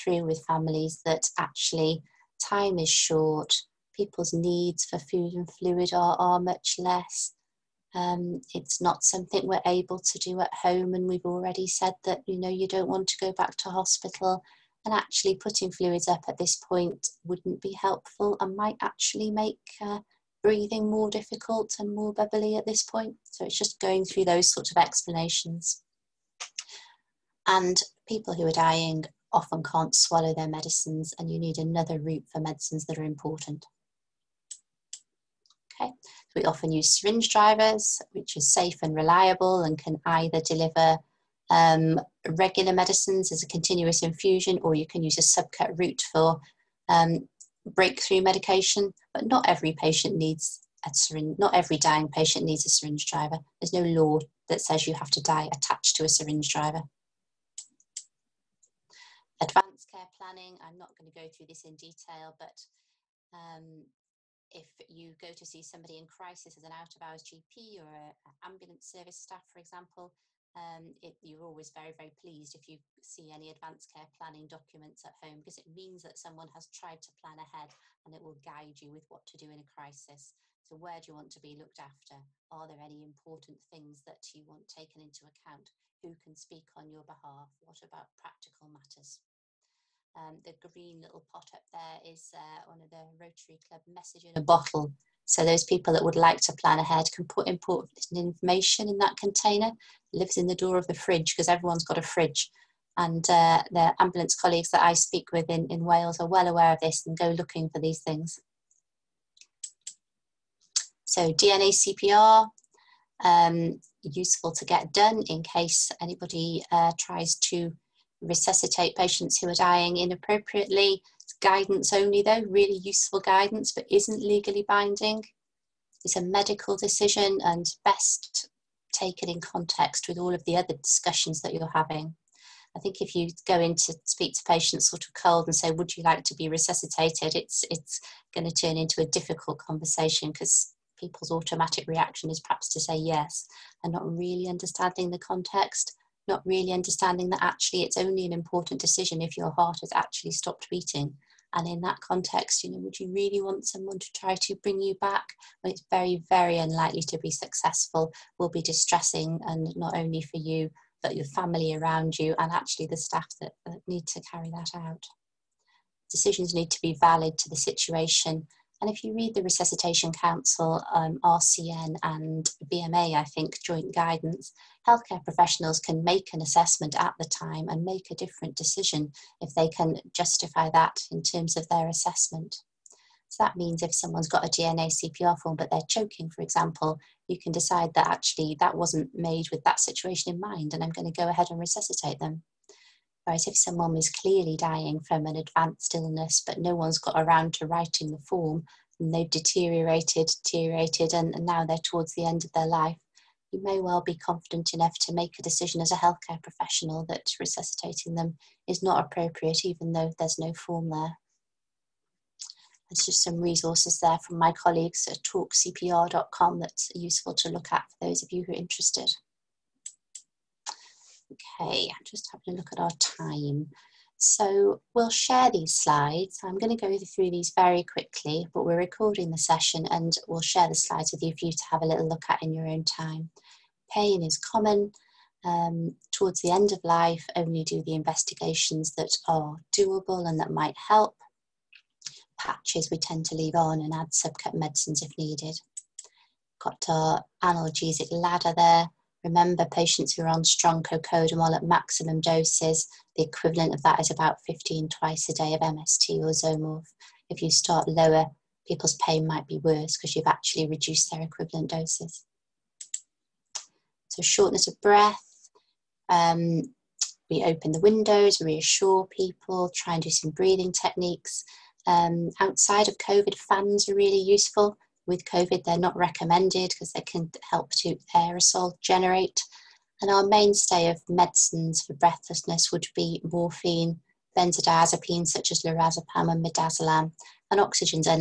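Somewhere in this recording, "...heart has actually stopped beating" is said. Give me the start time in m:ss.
2:29.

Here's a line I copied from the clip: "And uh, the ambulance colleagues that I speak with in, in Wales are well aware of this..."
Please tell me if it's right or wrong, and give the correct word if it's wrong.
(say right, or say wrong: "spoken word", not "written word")
right.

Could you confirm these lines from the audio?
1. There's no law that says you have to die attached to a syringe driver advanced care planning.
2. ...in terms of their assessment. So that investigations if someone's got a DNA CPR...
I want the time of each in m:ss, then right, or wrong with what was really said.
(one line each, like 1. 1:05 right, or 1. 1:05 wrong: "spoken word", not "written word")
1. 0:53 right
2. 3:01 wrong: "means", not "investigations".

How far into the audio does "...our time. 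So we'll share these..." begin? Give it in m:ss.
3:42.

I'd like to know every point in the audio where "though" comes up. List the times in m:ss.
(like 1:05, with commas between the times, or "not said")
2:02, 3:29.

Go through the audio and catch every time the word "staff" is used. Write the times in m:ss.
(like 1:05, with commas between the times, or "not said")
1:09, 2:42.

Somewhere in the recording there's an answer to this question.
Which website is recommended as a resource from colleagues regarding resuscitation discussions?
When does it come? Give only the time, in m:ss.
3:35.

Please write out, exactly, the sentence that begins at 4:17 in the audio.
If you start lower, people's pain might be worse because you've actually reduced their equivalent doses.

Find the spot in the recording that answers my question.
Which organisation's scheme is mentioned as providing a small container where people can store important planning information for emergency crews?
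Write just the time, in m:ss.
1:33.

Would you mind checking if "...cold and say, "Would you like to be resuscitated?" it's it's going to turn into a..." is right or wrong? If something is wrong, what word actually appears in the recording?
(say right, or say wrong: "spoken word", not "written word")
right.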